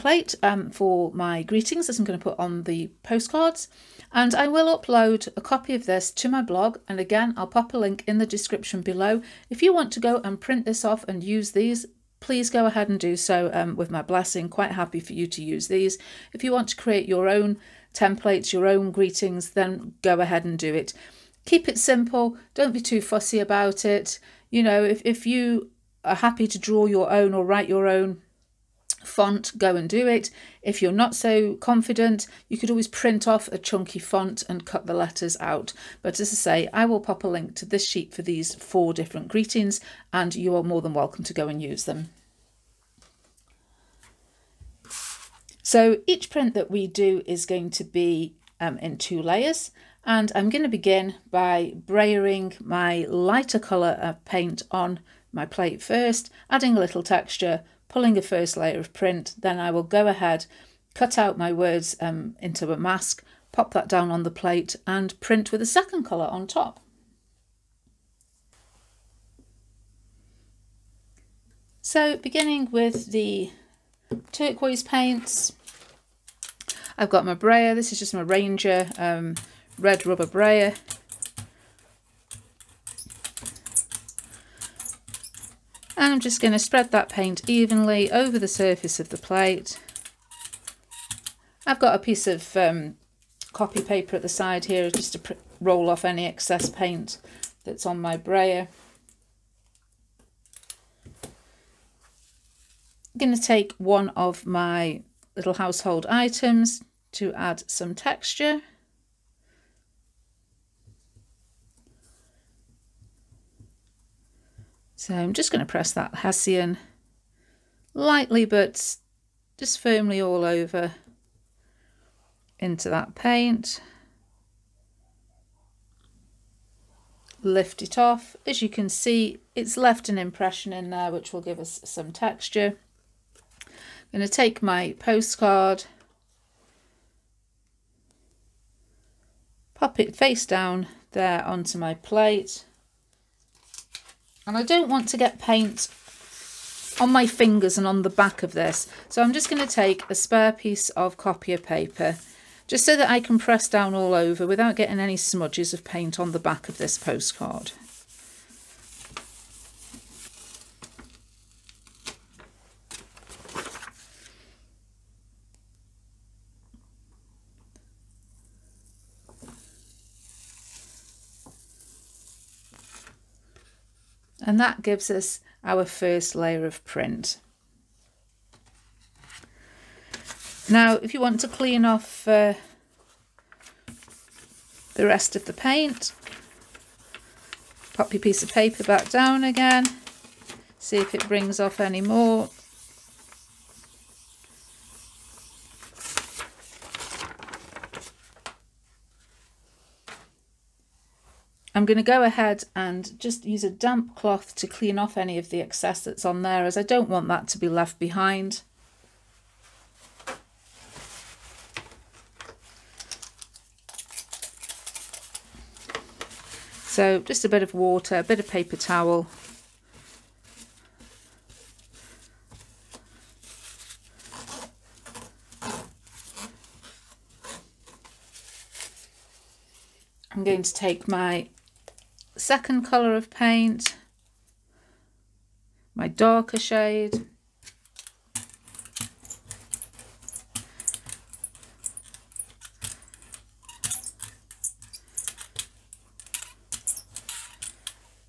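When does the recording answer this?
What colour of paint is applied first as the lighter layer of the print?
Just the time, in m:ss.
1:14.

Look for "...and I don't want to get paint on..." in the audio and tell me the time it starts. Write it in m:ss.
2:24.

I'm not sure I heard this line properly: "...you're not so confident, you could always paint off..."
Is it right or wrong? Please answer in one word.
wrong.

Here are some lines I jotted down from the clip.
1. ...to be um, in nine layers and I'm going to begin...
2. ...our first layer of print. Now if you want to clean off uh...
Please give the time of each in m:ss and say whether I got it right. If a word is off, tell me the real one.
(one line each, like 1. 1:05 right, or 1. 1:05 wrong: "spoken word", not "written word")
1. 0:47 wrong: "two", not "nine"
2. 2:55 right.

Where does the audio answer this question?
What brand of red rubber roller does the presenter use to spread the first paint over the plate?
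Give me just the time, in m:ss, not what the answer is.
1:18.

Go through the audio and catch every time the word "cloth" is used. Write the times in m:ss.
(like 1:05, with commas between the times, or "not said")
3:24.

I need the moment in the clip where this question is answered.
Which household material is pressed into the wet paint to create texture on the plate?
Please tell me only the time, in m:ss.
1:56.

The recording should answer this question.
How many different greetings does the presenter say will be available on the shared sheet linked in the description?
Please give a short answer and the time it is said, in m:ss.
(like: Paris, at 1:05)
4, at 0:38.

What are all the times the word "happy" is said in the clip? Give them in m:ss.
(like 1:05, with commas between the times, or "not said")
0:14, 0:26.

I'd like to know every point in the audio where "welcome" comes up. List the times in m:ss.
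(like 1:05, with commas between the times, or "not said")
0:40.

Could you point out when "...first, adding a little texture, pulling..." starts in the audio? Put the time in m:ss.
0:55.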